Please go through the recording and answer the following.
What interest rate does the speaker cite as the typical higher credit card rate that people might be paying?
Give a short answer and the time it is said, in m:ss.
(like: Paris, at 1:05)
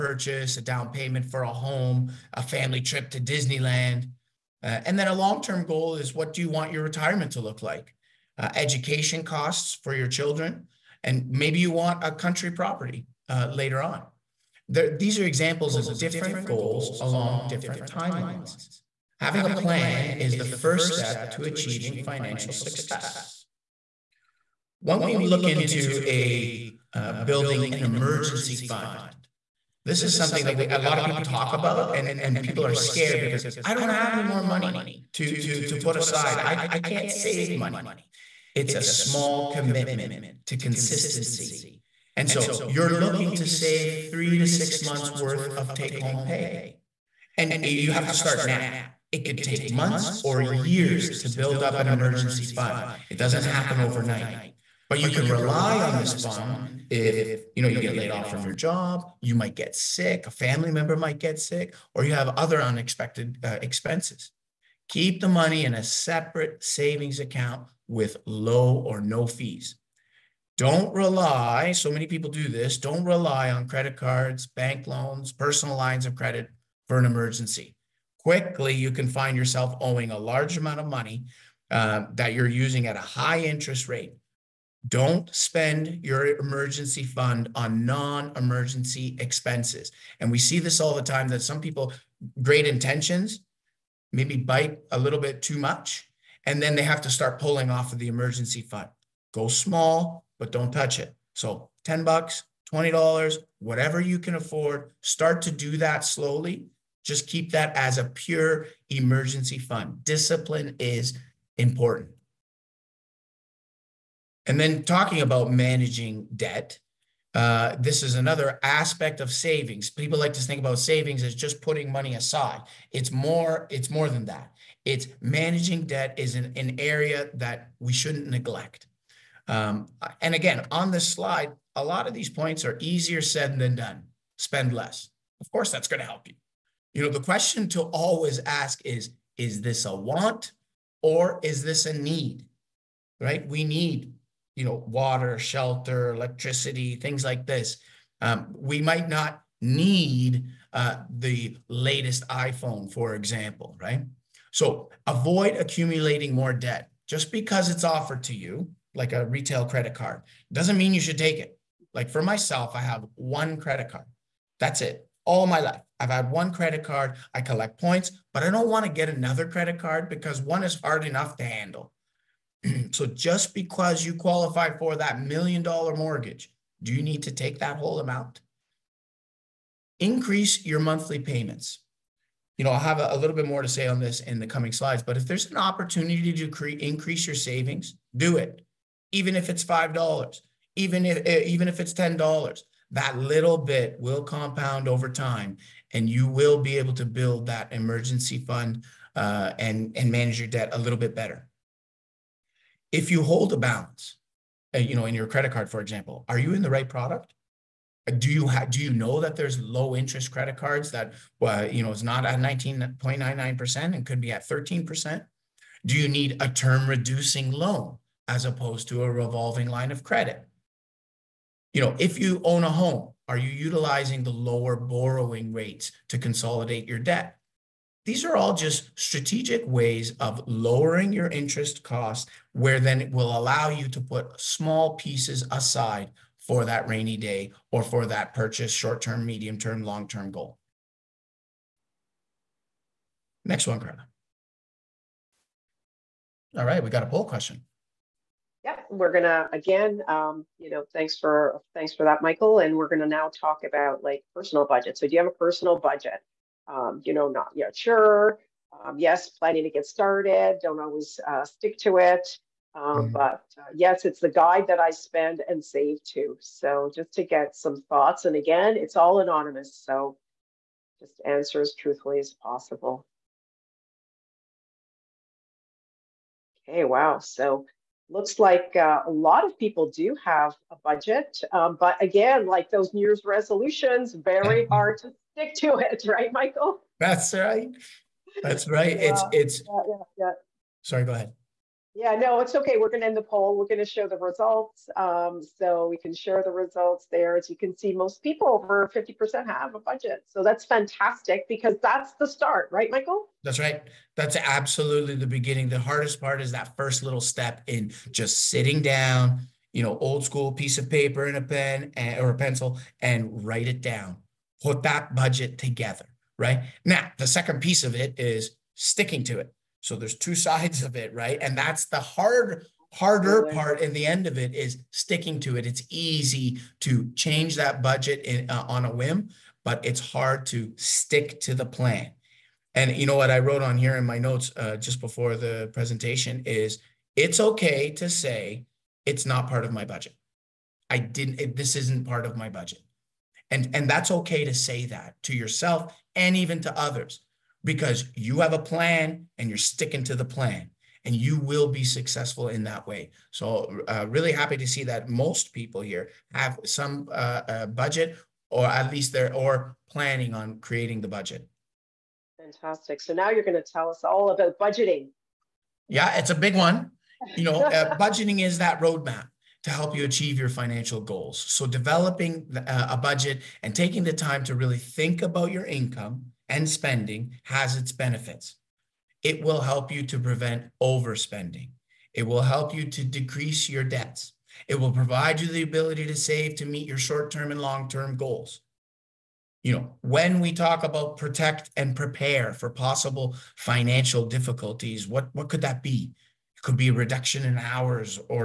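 19.99%, at 3:32.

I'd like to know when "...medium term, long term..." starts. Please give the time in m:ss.
3:59.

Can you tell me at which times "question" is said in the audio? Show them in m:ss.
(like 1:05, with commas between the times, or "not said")
2:17, 4:07.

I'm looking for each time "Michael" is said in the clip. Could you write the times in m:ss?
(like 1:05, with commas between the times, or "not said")
4:12, 4:46, 5:02.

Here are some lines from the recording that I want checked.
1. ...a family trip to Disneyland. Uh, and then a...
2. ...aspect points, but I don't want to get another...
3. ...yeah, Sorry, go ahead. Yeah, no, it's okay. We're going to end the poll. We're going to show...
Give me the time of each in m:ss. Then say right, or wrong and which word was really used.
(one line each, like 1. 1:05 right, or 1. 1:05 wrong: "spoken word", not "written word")
1. 0:02 right
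2. 2:47 wrong: "collect", not "aspect"
3. 4:50 right.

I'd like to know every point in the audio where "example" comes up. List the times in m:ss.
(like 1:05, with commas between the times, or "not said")
0:15, 2:33, 3:25.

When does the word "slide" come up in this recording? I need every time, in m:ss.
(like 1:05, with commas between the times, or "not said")
2:11, 3:04.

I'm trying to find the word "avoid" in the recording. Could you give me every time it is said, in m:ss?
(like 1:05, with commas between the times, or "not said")
2:35.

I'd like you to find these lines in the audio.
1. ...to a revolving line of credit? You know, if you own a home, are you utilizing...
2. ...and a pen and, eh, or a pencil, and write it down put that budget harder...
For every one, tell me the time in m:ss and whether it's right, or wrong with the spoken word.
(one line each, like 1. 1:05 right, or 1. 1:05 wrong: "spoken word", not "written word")
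1. 3:38 right
2. 5:11 wrong: "together", not "harder".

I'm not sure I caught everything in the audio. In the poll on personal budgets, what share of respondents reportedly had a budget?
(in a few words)
over 50%.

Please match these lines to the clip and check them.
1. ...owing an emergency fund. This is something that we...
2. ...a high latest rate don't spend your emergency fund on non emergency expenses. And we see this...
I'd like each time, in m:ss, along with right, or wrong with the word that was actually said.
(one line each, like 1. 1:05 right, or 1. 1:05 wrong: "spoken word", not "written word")
1. 0:27 wrong: "building", not "owing"
2. 1:22 wrong: "interest", not "latest".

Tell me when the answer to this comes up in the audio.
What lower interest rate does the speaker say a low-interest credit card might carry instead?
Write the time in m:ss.
3:34.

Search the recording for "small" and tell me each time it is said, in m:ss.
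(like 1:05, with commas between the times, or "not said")
0:38, 1:39, 3:54.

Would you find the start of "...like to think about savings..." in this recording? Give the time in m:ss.
2:00.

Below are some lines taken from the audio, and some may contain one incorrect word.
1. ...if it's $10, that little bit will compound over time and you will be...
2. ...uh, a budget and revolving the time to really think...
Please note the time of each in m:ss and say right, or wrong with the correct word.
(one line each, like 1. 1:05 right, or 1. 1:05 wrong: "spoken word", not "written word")
1. 3:11 right
2. 6:12 wrong: "taking", not "revolving".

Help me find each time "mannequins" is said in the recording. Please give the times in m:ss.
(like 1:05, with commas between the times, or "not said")
not said.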